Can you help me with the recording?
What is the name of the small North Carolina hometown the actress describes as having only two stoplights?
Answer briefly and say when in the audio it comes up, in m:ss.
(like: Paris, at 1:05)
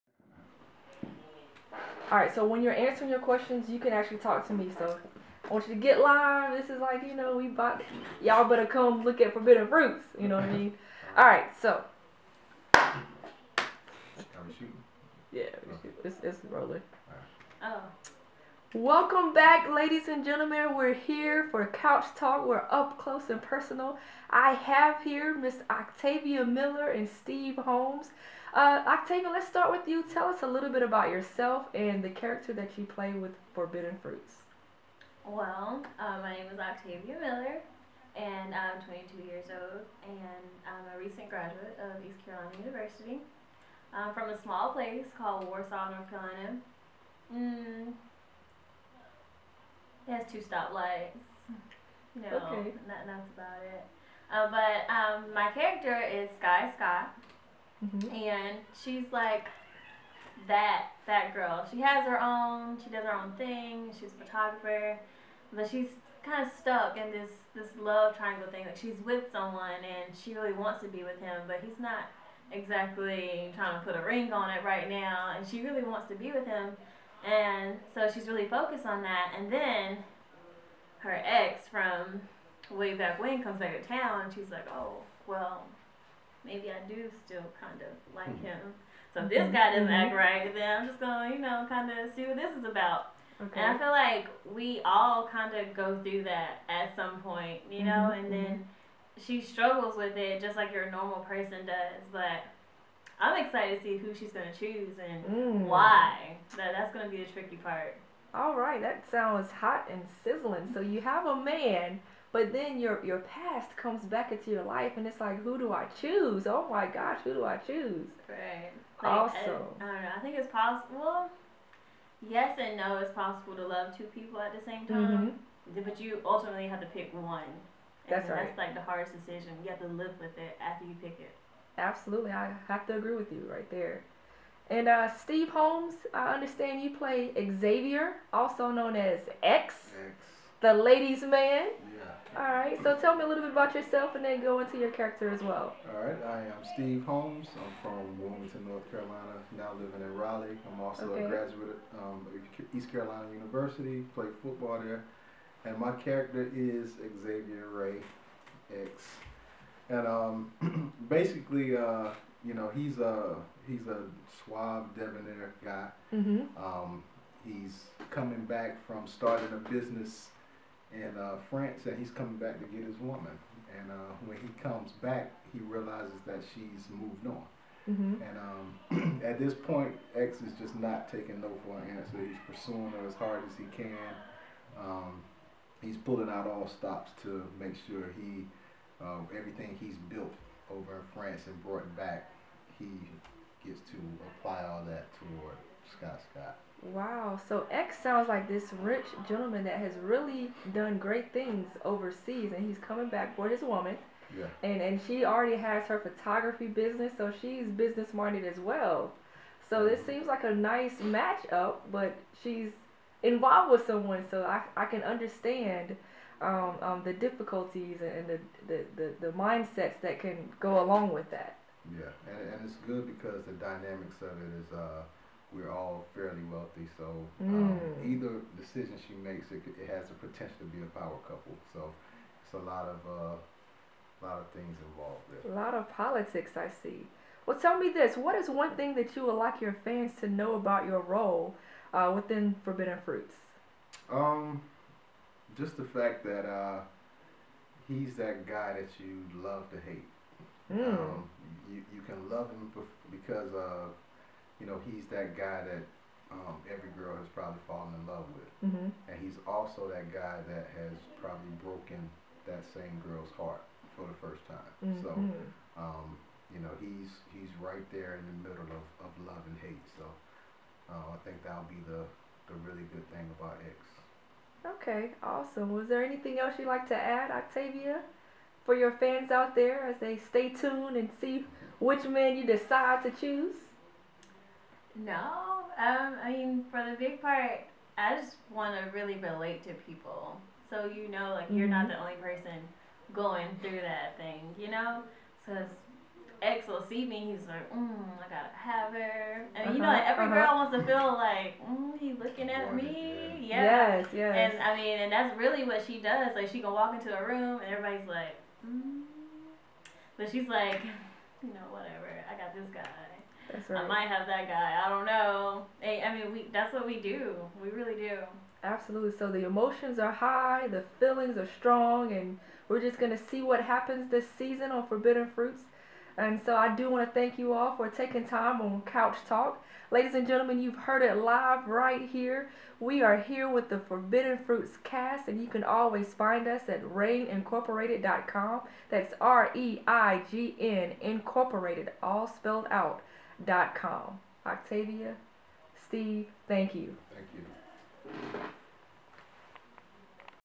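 Warsaw, at 0:45.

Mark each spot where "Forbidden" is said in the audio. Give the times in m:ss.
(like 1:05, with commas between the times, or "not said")
0:09, 0:33, 4:02, 5:24, 5:33.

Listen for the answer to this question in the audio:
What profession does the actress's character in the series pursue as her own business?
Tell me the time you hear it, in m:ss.
1:04.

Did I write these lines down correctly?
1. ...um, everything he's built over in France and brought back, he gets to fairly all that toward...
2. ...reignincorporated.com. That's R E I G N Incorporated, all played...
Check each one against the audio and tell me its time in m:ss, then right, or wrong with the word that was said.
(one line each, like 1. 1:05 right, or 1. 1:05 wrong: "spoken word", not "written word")
1. 3:09 wrong: "apply", not "fairly"
2. 5:36 wrong: "spelled", not "played".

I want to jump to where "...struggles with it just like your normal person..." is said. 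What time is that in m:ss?
1:39.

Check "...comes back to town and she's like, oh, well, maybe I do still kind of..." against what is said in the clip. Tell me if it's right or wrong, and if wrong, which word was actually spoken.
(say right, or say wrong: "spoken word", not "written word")
right.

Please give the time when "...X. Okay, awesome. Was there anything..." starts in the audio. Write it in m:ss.
4:33.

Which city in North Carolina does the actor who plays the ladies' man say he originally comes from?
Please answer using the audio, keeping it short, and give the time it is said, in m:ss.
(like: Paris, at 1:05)
Wilmington, at 2:28.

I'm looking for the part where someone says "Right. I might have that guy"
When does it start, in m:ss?
5:13.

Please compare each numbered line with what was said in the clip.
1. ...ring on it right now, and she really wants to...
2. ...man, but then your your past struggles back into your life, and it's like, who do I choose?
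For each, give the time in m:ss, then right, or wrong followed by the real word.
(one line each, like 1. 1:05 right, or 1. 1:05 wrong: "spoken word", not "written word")
1. 1:14 right
2. 1:51 wrong: "comes", not "struggles".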